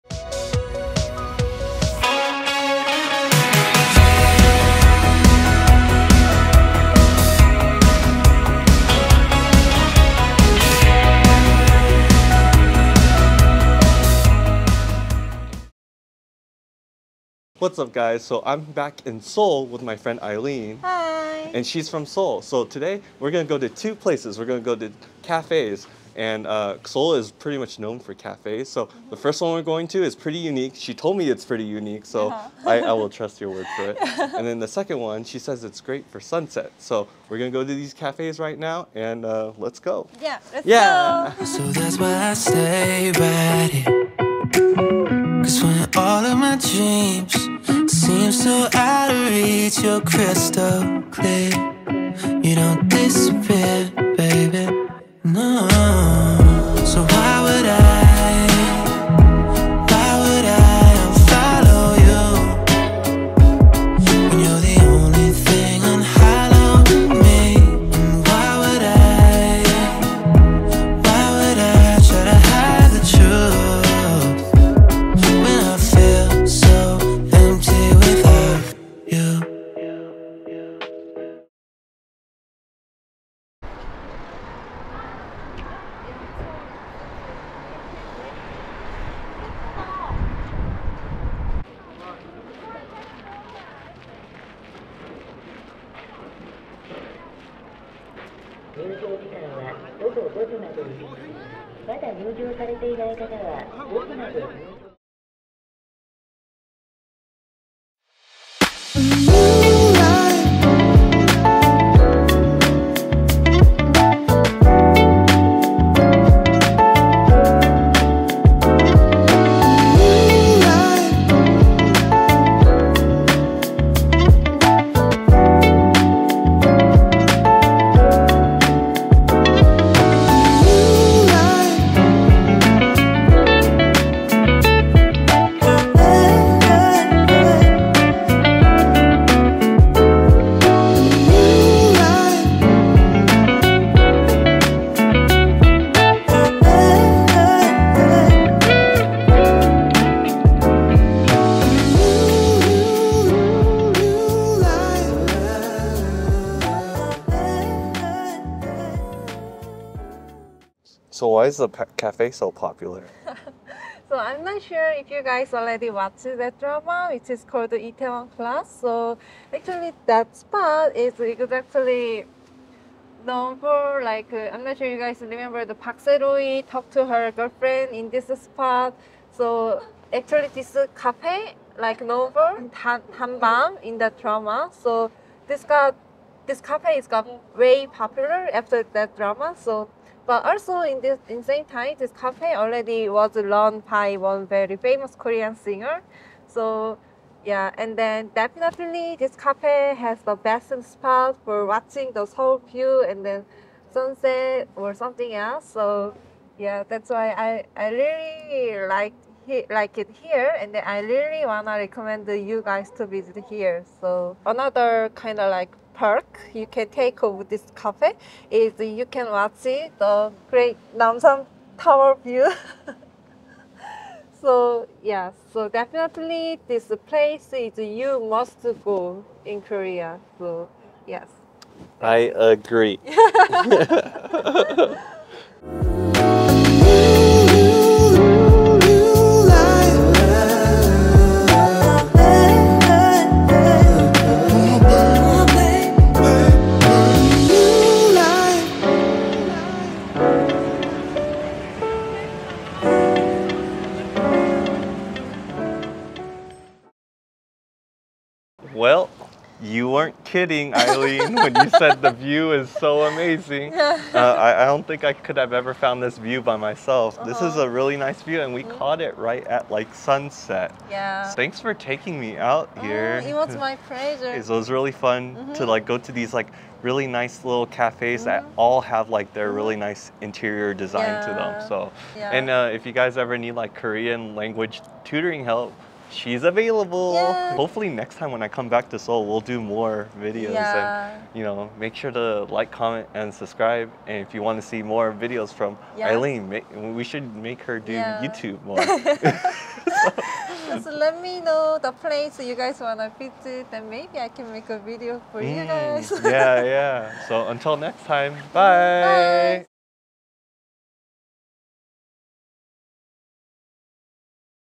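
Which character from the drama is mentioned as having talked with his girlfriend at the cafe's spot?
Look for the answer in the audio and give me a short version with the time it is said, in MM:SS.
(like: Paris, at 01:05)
Park Sae-ro-yi, at 02:55.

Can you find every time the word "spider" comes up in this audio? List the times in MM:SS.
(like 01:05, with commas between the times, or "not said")
not said.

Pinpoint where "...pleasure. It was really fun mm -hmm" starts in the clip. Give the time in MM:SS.
04:33.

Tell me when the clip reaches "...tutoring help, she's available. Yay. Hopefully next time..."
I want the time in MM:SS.
04:45.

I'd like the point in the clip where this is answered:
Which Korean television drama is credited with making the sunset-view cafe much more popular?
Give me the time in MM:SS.
02:47.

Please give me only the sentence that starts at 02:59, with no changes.
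So actually, this cafe like known for Han in that drama.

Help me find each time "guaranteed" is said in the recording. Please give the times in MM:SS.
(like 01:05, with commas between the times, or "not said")
not said.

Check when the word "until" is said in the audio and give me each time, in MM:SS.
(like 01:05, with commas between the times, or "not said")
05:07.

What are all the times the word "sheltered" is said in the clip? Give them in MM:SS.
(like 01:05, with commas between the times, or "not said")
not said.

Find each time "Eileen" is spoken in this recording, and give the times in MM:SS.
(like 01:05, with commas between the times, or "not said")
00:20, 04:20, 04:55.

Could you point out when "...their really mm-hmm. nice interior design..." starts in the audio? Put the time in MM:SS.
04:39.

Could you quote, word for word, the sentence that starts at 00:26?
And uh, Seoul is pretty much known for cafes.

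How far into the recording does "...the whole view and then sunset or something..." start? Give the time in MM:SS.
03:22.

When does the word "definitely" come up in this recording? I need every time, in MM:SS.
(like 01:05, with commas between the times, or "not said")
03:18, 03:45.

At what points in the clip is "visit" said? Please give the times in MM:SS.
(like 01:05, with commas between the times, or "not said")
03:33, 05:03.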